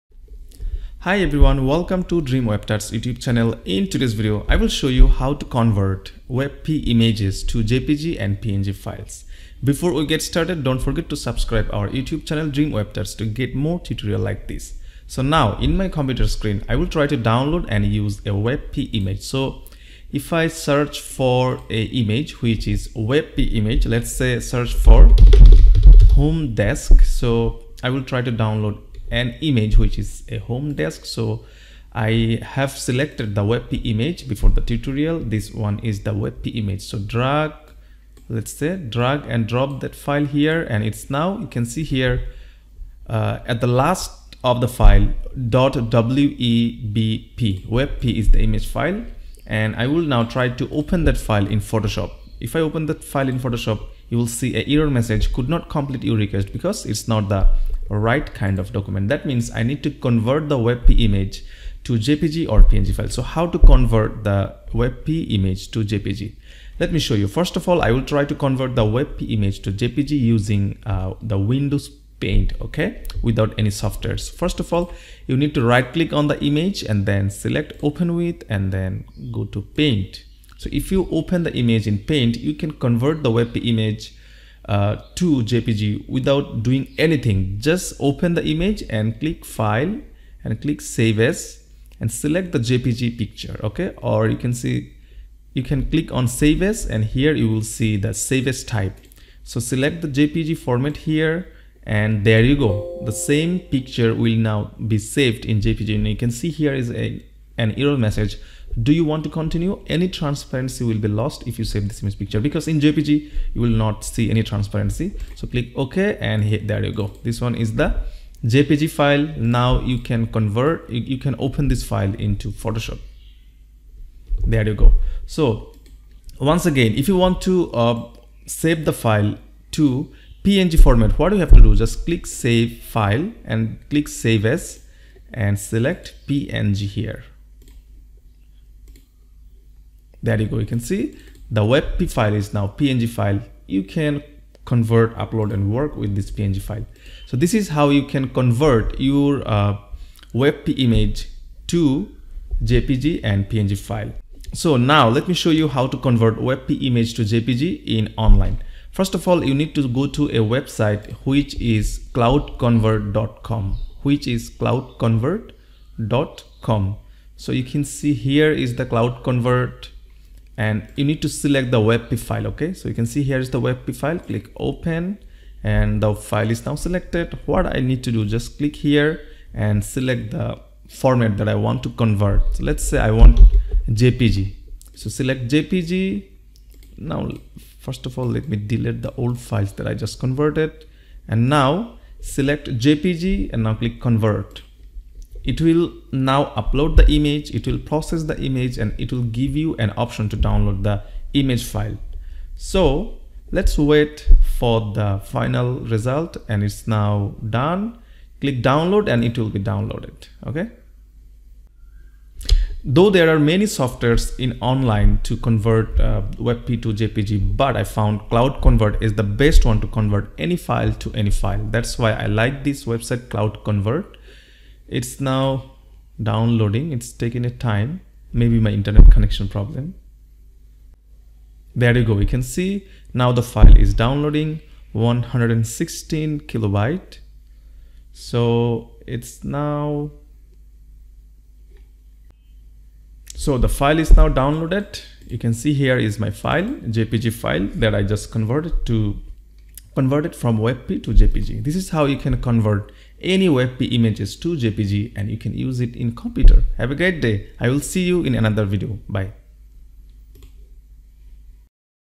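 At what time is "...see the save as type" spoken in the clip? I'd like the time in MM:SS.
01:37.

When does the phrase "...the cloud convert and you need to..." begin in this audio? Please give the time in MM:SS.
02:48.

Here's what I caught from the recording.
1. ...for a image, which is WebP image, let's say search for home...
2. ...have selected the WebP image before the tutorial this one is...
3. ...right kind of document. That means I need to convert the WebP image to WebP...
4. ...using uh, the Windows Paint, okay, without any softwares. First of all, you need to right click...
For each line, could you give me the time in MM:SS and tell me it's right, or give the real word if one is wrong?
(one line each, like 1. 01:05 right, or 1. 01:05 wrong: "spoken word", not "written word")
1. 00:21 right
2. 00:32 right
3. 00:57 wrong: "JPG", not "WebP"
4. 01:10 right.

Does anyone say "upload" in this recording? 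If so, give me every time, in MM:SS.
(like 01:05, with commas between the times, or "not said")
02:25, 03:16.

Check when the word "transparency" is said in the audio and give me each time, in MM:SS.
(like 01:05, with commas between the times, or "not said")
01:50, 01:54.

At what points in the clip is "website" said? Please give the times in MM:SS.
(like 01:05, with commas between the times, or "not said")
02:40, 03:42.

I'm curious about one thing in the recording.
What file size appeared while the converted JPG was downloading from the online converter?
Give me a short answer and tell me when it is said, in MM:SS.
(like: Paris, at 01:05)
116 kilobytes, at 03:54.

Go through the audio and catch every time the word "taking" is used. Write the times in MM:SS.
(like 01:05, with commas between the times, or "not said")
03:47.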